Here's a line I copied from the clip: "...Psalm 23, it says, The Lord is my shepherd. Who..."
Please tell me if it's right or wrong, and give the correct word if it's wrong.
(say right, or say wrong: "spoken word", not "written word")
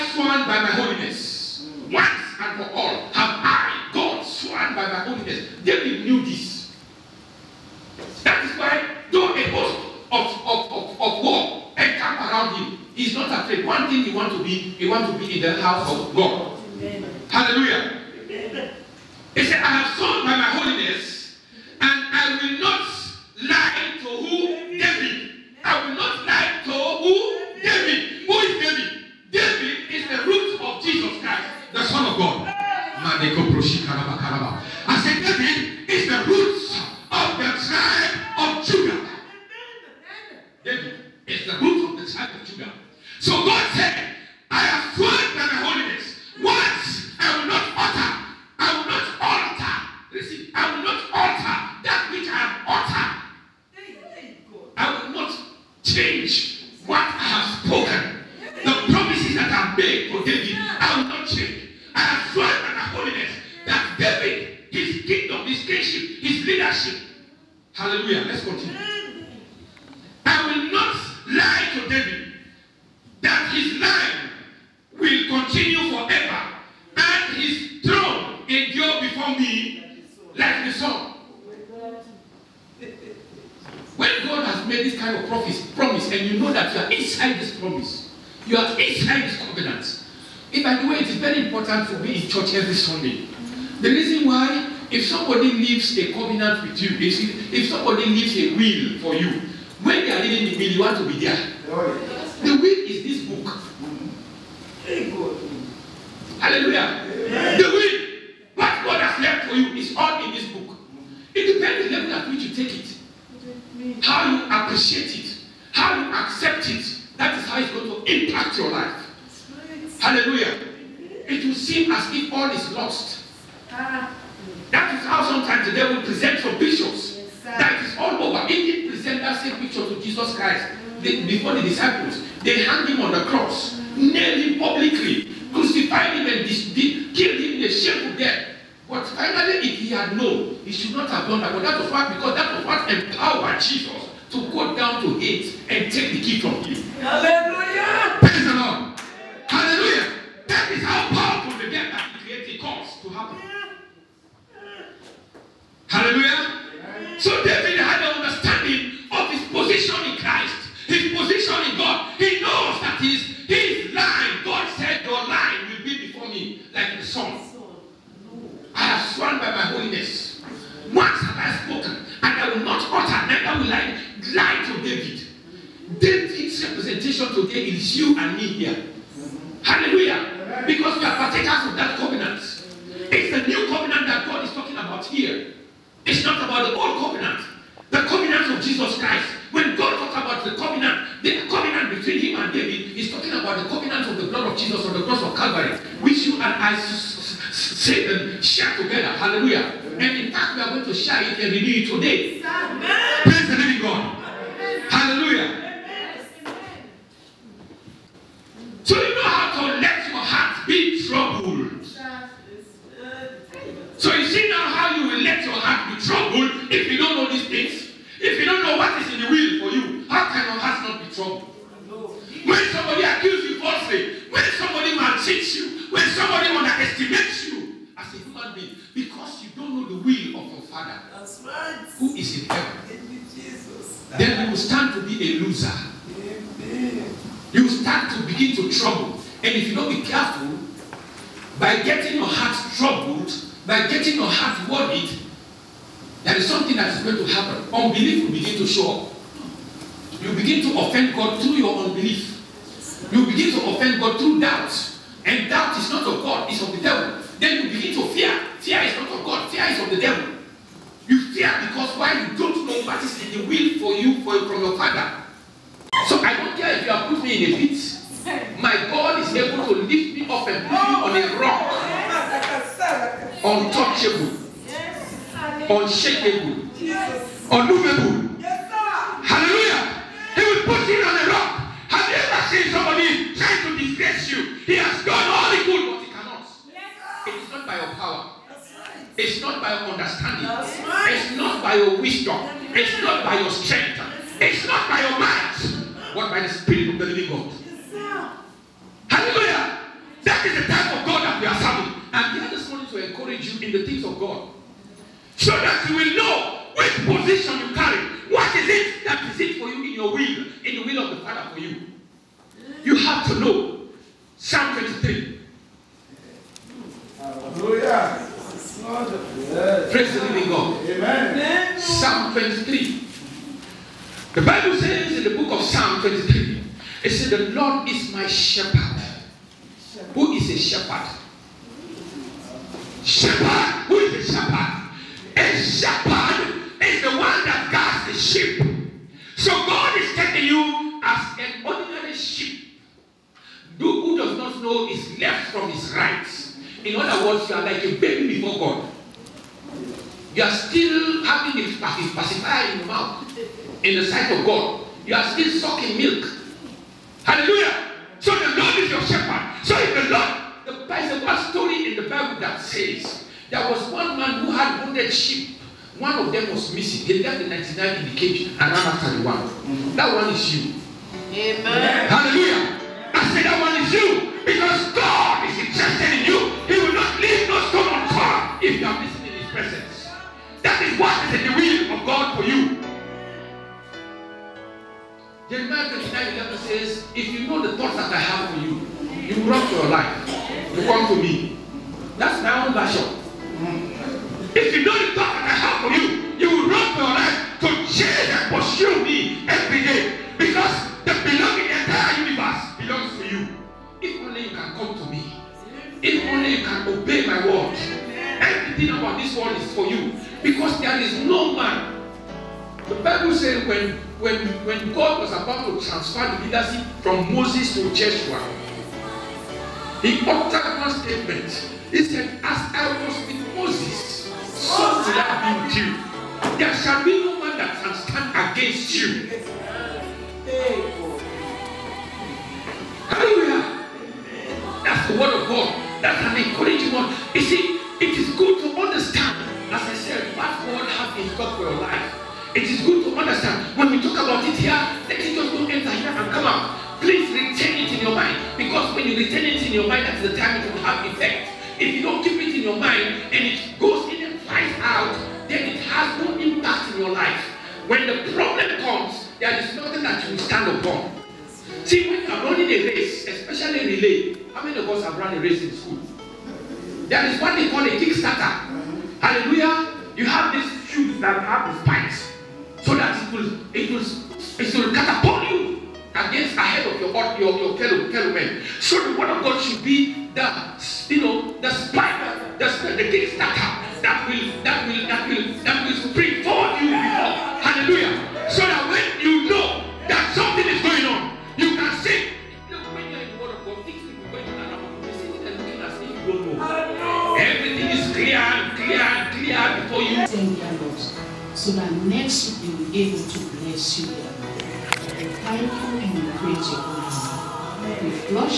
right.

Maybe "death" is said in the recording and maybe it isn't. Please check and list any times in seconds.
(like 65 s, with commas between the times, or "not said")
138 s, 151 s.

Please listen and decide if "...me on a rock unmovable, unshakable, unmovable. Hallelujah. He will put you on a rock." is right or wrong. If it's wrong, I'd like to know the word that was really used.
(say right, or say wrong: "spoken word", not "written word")
wrong: "untouchable", not "unmovable".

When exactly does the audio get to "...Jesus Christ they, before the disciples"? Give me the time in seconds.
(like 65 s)
130 s.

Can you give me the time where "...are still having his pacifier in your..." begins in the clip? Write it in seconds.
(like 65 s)
350 s.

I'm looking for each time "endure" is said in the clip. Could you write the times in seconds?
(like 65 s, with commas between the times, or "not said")
78 s.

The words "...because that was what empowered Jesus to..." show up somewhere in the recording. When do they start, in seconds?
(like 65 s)
142 s.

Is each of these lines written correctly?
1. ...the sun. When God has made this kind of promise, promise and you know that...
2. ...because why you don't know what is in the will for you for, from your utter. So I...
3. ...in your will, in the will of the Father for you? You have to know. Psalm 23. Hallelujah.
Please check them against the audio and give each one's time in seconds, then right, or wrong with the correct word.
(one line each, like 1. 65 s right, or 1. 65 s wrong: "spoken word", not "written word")
1. 80 s right
2. 261 s wrong: "father", not "utter"
3. 309 s right.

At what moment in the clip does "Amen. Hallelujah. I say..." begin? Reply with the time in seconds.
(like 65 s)
371 s.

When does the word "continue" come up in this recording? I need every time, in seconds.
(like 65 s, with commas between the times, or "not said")
68 s, 75 s.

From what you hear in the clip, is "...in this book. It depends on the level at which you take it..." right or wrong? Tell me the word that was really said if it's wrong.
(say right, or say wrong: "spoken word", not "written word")
right.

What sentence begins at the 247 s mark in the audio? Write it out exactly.
Unbelief will begin to show up.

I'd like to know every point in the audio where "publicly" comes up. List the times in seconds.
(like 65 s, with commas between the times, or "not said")
134 s.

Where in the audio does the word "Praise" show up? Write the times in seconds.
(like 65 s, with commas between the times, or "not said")
148 s, 319 s.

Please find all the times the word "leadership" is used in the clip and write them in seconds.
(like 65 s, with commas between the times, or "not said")
66 s, 416 s.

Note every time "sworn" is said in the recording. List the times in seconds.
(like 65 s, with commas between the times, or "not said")
0 s, 4 s, 19 s, 169 s.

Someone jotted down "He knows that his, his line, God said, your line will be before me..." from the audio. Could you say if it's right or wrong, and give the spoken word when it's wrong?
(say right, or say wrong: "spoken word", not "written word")
right.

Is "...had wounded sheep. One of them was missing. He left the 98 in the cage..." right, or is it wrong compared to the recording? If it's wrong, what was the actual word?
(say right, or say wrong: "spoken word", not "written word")
wrong: "99", not "98".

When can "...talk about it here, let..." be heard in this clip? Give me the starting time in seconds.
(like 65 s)
444 s.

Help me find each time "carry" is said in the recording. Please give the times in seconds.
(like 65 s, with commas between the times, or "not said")
307 s.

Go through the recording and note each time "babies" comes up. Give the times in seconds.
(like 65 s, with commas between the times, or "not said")
not said.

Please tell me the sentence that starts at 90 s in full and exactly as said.
And by the way, it is very important for me in church every Sunday.